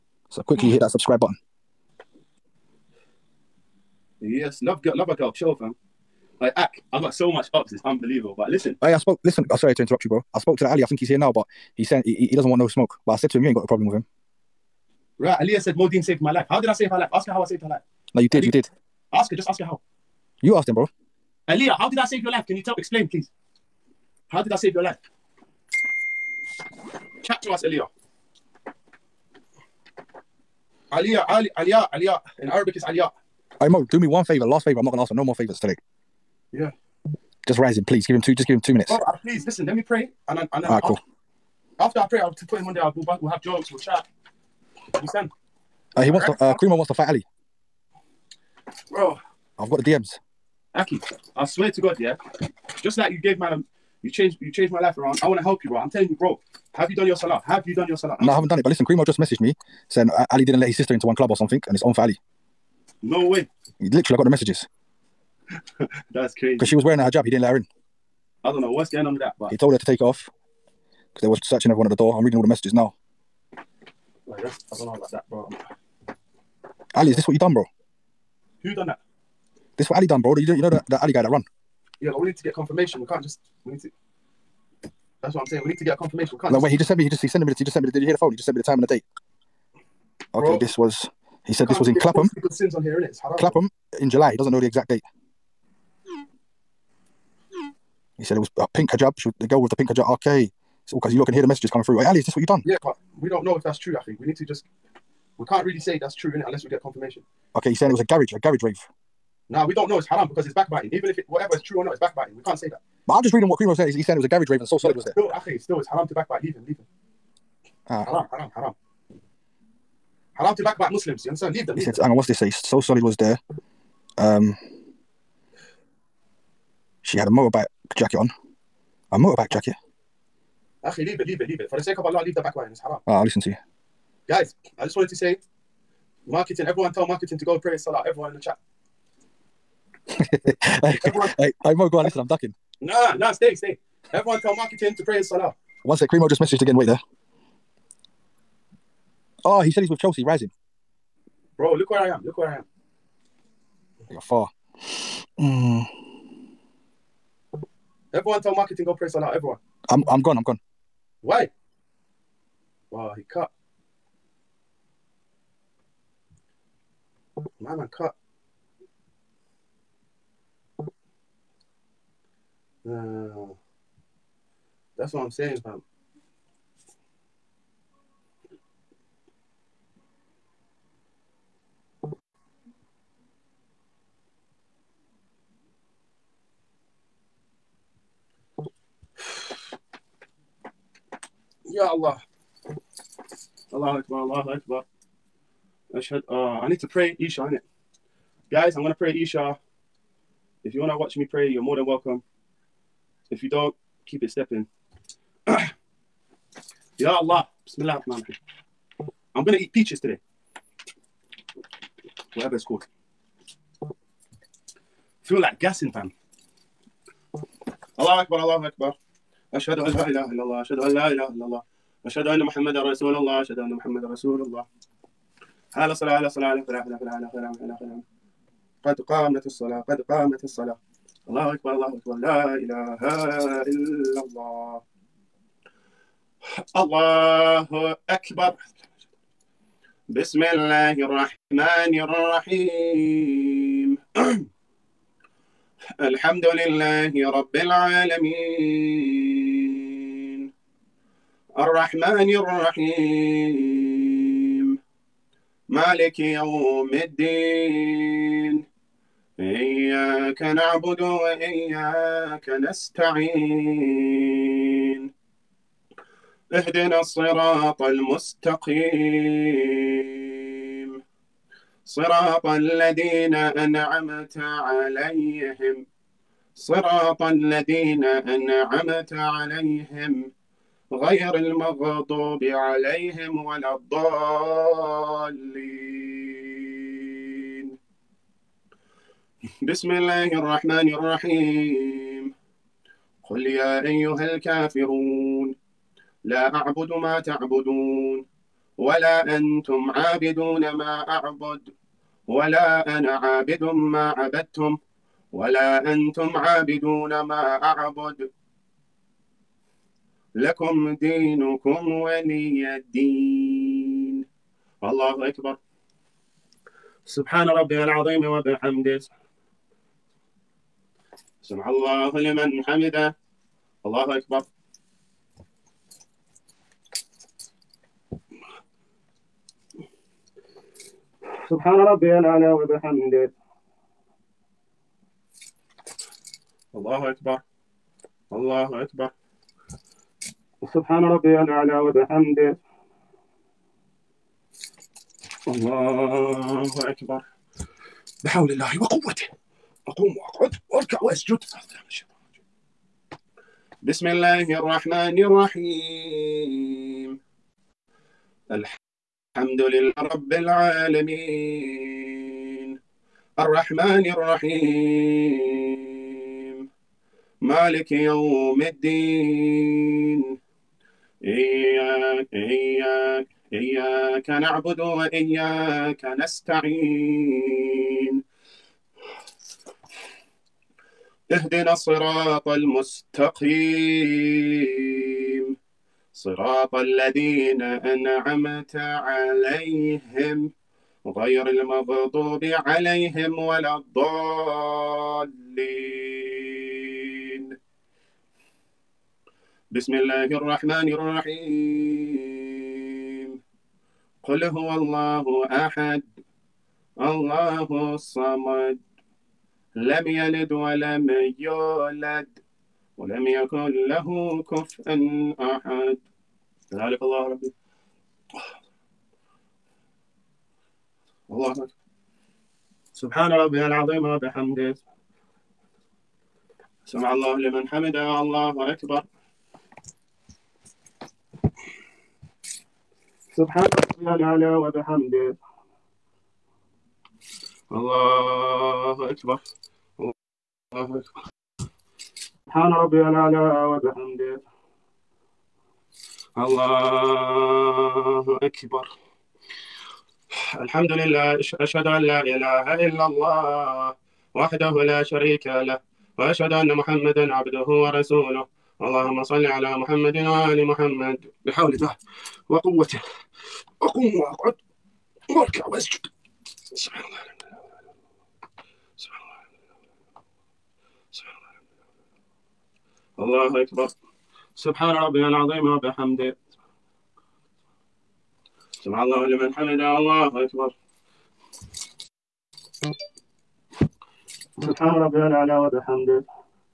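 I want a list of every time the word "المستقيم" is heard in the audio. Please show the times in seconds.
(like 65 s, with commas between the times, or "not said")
267 s, 382 s.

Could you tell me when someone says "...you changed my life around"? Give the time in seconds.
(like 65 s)
54 s.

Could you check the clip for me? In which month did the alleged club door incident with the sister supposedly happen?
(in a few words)
July.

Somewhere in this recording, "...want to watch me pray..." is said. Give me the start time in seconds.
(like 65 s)
200 s.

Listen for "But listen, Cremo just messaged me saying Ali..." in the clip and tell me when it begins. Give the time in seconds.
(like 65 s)
58 s.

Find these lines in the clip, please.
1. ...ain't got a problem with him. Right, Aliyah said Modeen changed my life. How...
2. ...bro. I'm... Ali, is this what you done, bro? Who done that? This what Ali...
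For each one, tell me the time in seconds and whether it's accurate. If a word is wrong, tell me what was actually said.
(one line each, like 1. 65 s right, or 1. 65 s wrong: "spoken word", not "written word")
1. 13 s wrong: "saved", not "changed"
2. 75 s right.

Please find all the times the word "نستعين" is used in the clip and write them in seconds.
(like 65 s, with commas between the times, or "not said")
262 s, 376 s.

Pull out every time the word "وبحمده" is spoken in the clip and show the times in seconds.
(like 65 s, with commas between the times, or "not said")
318 s, 332 s, 341 s, 424 s, 434 s, 443 s, 475 s, 485 s.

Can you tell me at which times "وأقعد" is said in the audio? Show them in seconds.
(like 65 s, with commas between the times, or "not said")
350 s, 464 s.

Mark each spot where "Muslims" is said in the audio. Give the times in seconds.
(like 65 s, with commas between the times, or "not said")
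120 s.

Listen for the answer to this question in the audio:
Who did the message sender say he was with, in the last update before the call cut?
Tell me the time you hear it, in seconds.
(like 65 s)
149 s.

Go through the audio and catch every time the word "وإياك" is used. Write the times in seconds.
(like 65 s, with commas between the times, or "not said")
261 s, 374 s.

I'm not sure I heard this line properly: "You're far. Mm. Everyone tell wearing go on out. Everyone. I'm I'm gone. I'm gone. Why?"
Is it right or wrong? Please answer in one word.
wrong.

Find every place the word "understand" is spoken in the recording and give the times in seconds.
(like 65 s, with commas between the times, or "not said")
44 s, 121 s.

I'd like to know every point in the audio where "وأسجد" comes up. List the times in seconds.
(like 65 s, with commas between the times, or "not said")
351 s, 465 s.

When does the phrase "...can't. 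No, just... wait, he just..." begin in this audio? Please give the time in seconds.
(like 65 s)
86 s.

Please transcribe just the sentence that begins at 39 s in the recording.
Let me pray, and then, and then right, after, cool.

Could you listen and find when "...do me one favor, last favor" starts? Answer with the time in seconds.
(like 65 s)
33 s.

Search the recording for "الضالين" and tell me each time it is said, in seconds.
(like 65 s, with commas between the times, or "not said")
283 s, 393 s.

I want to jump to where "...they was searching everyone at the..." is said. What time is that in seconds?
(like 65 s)
71 s.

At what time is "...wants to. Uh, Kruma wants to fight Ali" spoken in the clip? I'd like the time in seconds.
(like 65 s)
46 s.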